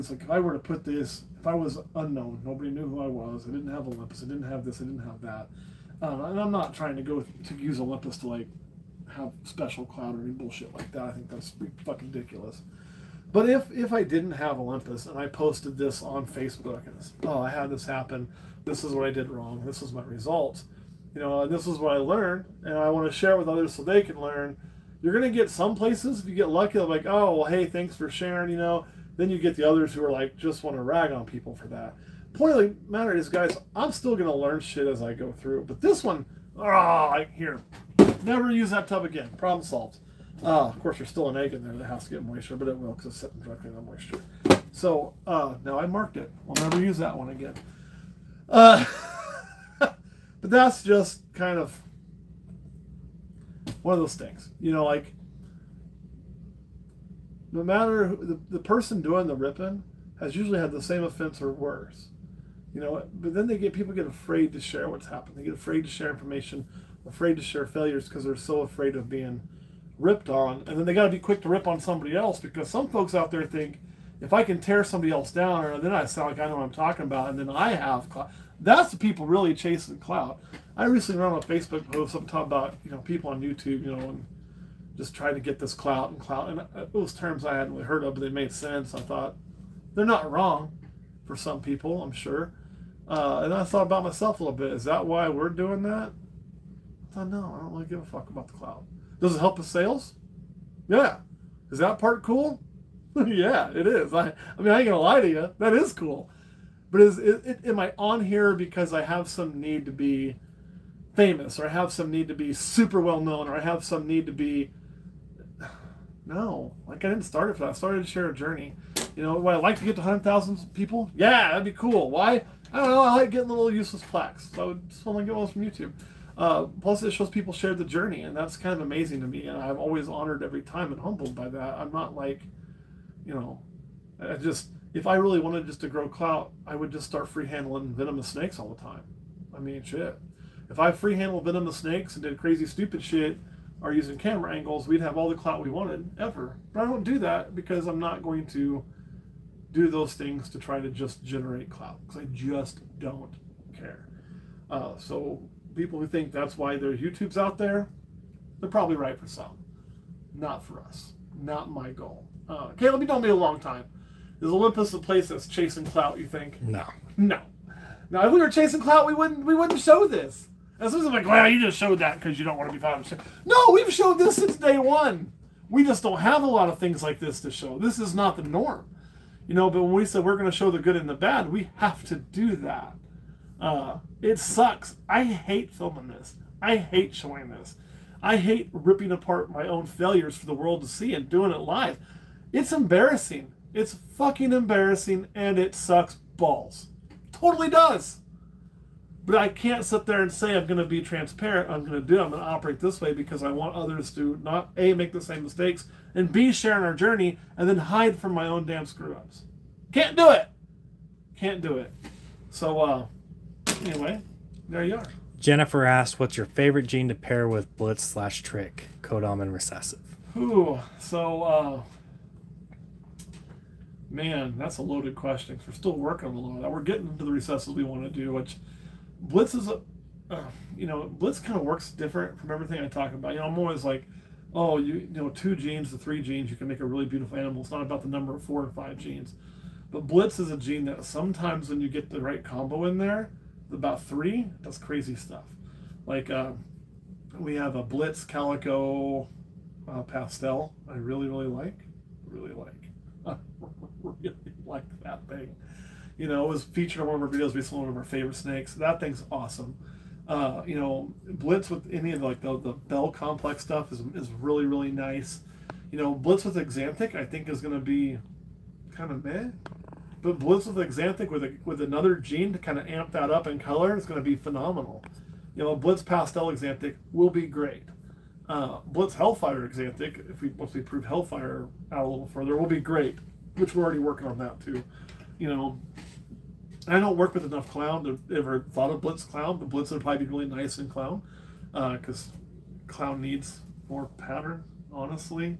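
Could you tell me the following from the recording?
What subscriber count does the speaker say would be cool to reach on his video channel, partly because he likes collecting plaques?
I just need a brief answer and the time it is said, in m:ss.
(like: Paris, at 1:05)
100,000, at 2:00.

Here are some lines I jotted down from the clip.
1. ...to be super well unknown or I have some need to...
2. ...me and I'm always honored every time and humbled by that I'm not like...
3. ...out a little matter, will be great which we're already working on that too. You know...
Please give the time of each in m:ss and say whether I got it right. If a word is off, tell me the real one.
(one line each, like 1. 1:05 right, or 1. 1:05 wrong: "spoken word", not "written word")
1. 1:52 wrong: "known", not "unknown"
2. 2:09 right
3. 4:41 wrong: "further", not "matter".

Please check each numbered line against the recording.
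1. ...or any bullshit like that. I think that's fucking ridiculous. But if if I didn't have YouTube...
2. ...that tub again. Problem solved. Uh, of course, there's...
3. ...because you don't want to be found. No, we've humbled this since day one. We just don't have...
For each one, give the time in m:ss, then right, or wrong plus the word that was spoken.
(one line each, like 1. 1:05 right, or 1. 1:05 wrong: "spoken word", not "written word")
1. 0:10 wrong: "Olympus", not "YouTube"
2. 0:38 right
3. 2:52 wrong: "showed", not "humbled".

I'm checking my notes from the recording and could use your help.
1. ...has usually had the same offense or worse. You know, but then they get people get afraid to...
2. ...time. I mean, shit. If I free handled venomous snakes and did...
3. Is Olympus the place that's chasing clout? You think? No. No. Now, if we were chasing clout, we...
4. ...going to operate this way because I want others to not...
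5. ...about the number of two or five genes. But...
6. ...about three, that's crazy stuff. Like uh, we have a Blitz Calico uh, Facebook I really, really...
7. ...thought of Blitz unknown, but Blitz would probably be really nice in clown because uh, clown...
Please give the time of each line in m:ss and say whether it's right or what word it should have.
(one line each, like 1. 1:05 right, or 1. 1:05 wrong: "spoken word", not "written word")
1. 1:00 right
2. 2:18 right
3. 2:44 right
4. 3:22 right
5. 3:57 wrong: "four", not "two"
6. 4:03 wrong: "Pastel", not "Facebook"
7. 4:48 wrong: "clown", not "unknown".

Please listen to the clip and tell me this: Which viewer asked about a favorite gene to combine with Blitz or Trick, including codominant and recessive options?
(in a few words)
Jennifer.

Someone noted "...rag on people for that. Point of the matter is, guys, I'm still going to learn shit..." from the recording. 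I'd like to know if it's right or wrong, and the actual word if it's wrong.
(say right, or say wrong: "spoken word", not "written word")
right.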